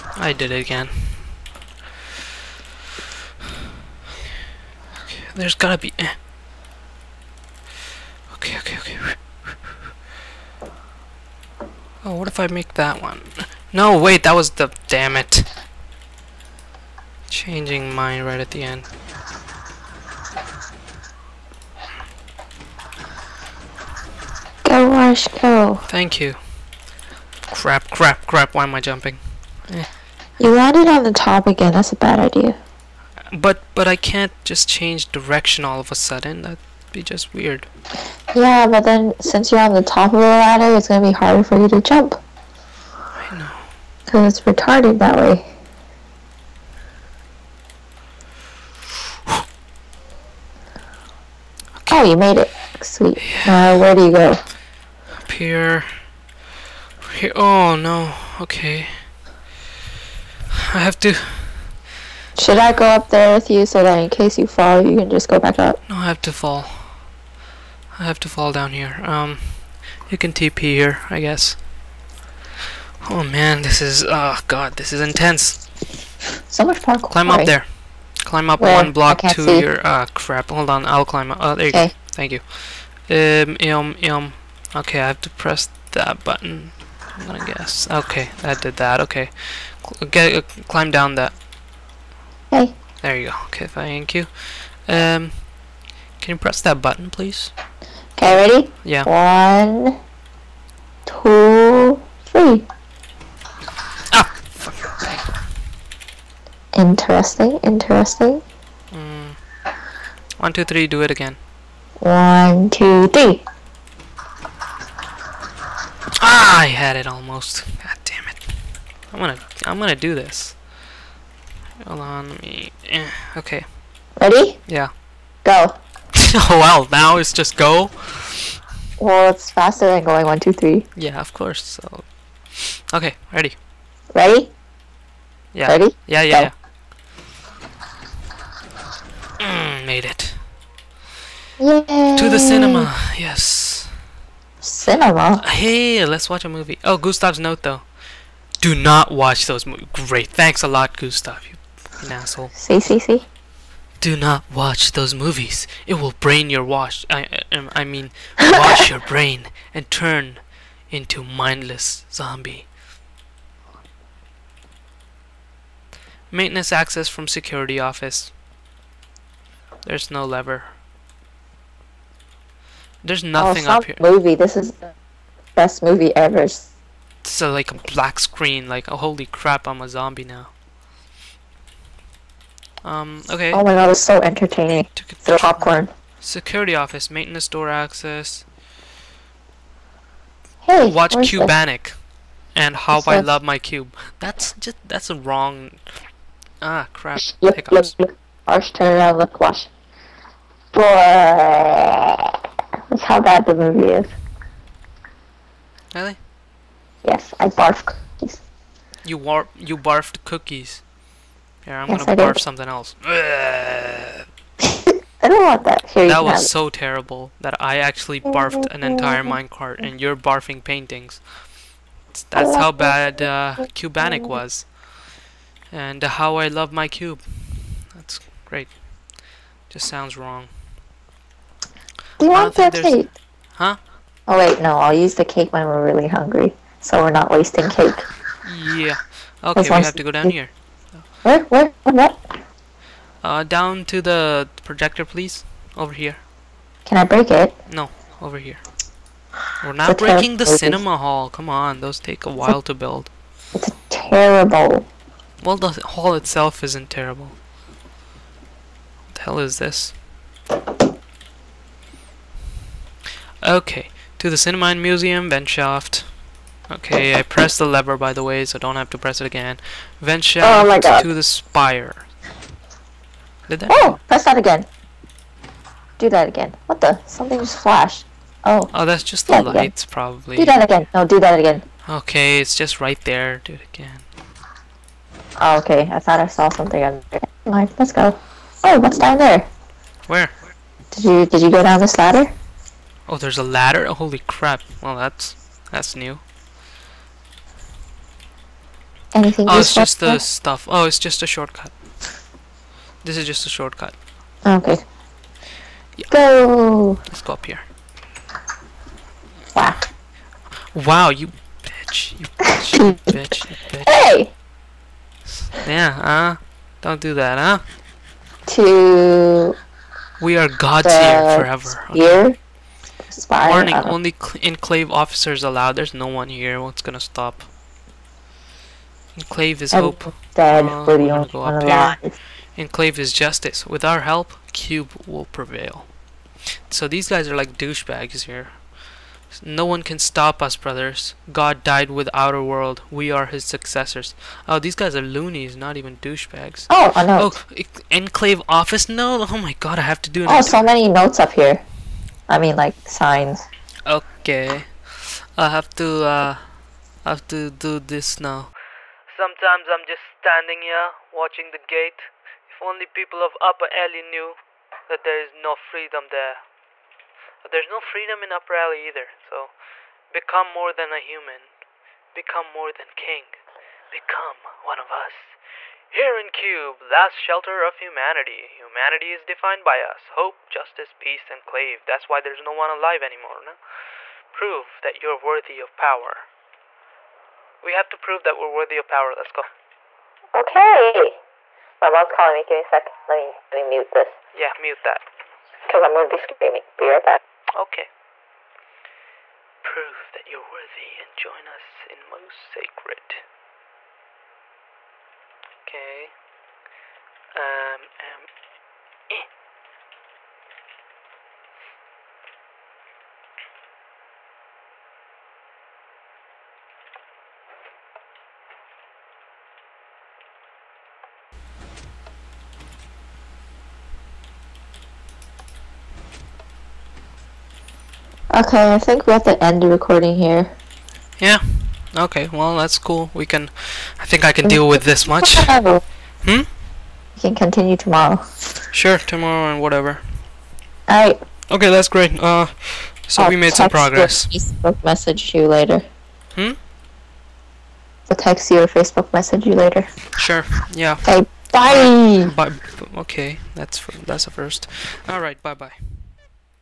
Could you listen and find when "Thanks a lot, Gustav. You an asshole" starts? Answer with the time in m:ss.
2:30.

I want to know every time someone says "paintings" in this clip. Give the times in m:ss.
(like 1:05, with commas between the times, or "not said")
3:40.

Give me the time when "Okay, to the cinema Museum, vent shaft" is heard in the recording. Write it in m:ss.
4:23.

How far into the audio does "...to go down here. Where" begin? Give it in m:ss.
3:59.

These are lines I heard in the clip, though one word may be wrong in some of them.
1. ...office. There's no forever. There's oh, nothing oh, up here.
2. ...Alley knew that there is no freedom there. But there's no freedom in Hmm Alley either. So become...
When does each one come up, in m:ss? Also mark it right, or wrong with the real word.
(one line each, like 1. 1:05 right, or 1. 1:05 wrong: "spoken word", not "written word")
1. 2:47 wrong: "lever", not "forever"
2. 6:03 wrong: "Upper", not "Hmm".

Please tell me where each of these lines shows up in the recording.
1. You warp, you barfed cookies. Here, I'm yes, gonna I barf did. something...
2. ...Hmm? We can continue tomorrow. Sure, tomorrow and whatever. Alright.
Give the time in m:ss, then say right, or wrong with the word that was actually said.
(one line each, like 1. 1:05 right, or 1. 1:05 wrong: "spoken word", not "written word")
1. 3:29 right
2. 7:16 right.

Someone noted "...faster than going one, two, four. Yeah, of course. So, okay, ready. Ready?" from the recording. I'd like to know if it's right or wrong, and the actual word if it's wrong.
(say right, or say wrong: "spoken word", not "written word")
wrong: "three", not "four".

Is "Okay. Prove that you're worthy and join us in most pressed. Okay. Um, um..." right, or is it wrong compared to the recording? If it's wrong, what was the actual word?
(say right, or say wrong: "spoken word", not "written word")
wrong: "sacred", not "pressed".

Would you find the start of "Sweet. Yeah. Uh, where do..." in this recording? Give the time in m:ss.
0:52.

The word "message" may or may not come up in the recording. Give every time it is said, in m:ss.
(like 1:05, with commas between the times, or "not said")
7:24, 7:29.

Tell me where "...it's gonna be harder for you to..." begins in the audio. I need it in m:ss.
0:40.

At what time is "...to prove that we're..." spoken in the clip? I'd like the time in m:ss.
6:27.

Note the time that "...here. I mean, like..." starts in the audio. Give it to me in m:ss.
5:51.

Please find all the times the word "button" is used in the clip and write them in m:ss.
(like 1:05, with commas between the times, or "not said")
1:26, 1:36.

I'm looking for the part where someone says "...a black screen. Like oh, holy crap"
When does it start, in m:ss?
2:57.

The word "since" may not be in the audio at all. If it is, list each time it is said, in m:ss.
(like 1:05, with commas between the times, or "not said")
0:39.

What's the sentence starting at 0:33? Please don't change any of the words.
But, but I can't just change direction all of a sudden.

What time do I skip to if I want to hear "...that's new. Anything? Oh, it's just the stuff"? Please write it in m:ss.
4:55.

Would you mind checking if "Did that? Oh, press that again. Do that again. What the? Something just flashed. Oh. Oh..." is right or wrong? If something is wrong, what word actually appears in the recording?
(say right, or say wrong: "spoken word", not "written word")
right.